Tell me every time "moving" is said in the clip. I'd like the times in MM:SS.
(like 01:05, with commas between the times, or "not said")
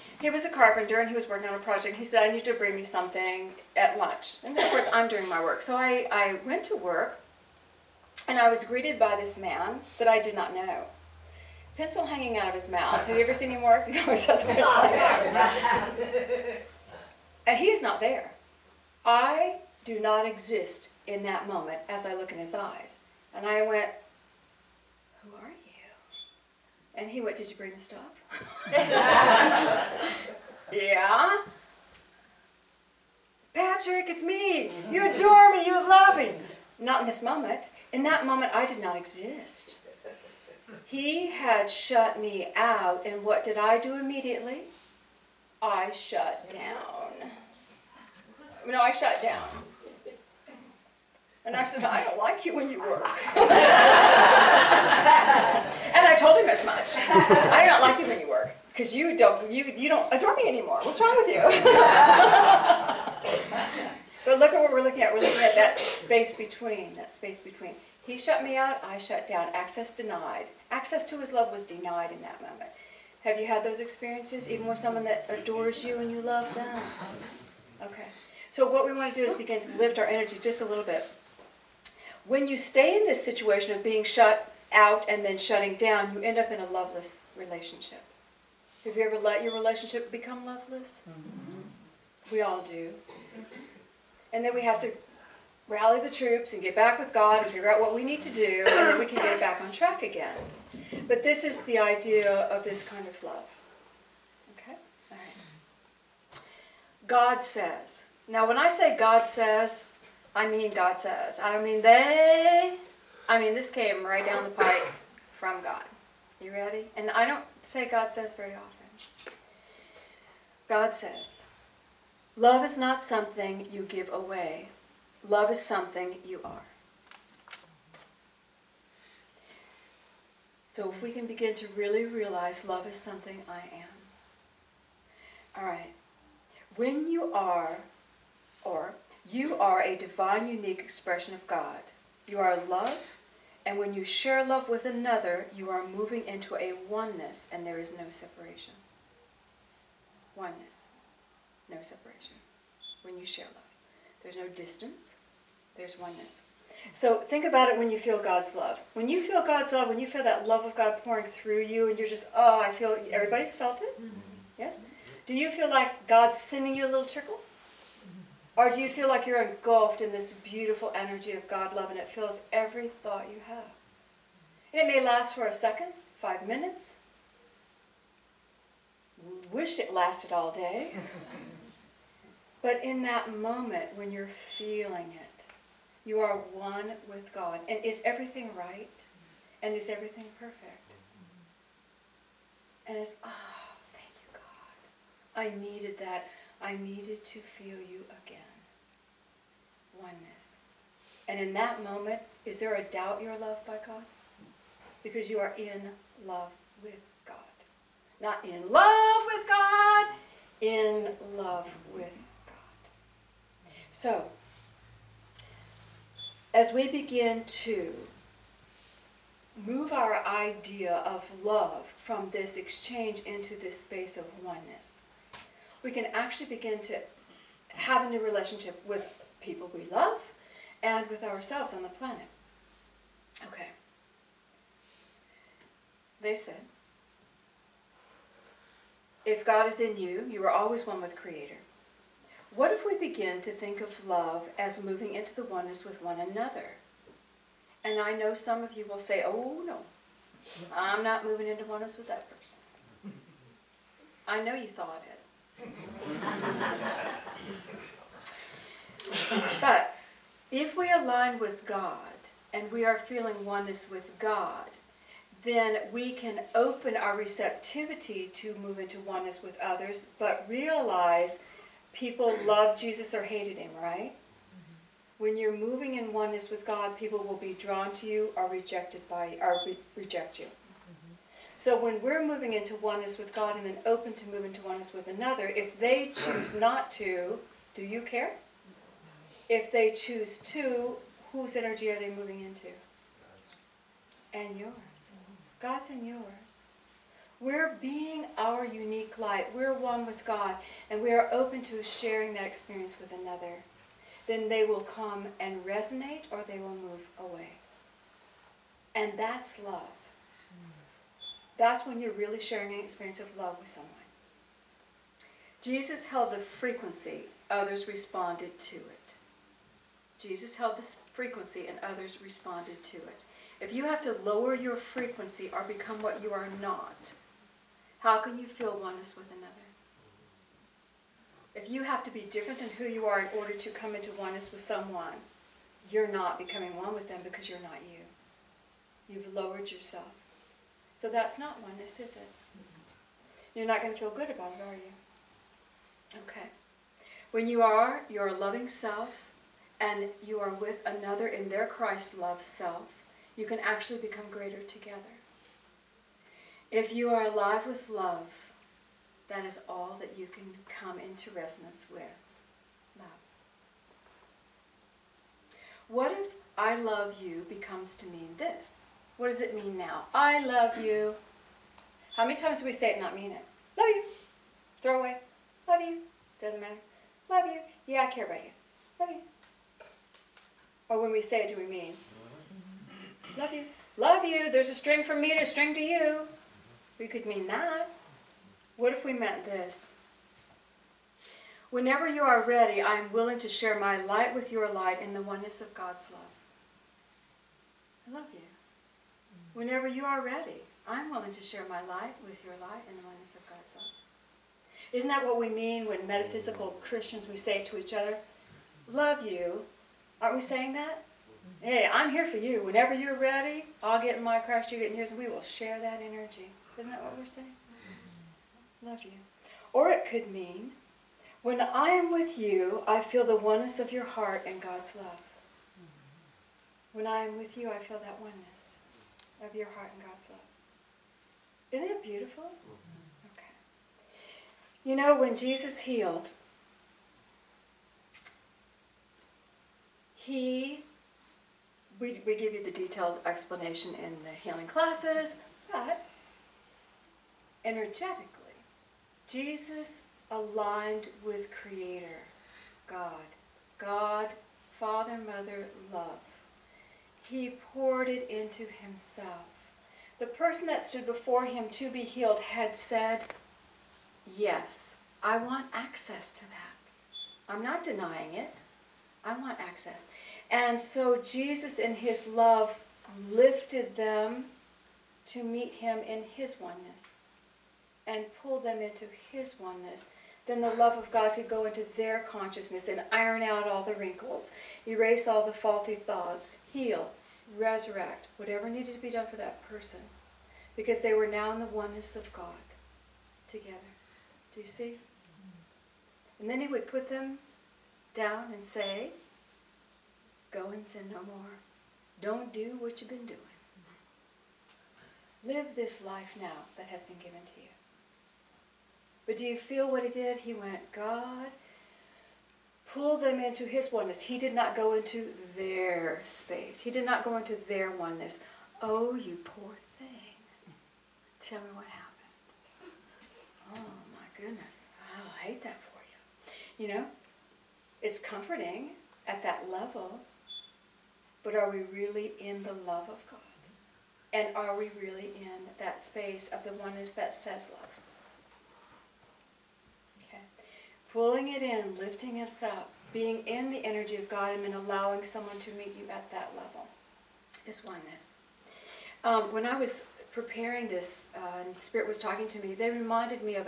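02:25, 04:04, 04:11, 04:35, 04:42, 04:52.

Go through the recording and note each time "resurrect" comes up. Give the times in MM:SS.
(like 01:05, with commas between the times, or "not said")
08:07.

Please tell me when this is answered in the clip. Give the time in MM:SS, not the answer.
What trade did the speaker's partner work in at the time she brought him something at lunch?
00:00.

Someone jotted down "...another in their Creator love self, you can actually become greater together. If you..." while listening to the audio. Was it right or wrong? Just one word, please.
wrong.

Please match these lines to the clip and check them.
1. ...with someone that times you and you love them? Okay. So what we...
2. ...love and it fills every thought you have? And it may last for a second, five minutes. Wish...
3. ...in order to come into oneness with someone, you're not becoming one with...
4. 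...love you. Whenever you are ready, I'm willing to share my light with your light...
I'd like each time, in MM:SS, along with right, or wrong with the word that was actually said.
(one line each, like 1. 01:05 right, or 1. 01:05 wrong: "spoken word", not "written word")
1. 01:14 wrong: "adores", not "times"
2. 02:51 right
3. 05:33 right
4. 06:38 right.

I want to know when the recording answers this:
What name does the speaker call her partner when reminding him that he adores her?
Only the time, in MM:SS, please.
00:33.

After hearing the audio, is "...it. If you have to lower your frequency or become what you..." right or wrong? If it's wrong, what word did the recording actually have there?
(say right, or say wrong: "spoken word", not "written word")
right.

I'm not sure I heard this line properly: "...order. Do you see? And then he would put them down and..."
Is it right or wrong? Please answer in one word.
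wrong.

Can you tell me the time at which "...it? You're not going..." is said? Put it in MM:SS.
05:42.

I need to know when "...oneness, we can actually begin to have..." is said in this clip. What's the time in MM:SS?
03:44.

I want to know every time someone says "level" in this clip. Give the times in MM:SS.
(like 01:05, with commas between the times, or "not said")
08:49, 09:06.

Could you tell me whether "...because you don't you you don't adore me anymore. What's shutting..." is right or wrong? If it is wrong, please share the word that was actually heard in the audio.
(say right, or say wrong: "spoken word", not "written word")
wrong: "wrong", not "shutting".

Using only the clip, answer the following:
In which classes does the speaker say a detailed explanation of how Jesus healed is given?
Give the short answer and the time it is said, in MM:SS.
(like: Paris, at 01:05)
Healing classes, at 07:24.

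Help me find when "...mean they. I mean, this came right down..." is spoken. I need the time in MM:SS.
01:51.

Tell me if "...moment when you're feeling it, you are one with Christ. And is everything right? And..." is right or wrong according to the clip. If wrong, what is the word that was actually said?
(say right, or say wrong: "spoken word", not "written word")
wrong: "God", not "Christ".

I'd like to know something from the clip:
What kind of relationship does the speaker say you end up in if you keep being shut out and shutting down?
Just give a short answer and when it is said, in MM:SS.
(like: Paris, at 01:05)
Loveless relationship, at 01:26.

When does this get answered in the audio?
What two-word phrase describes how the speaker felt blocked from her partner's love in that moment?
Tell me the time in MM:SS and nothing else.
01:09.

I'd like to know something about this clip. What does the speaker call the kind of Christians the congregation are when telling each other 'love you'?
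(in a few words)
Metaphysical.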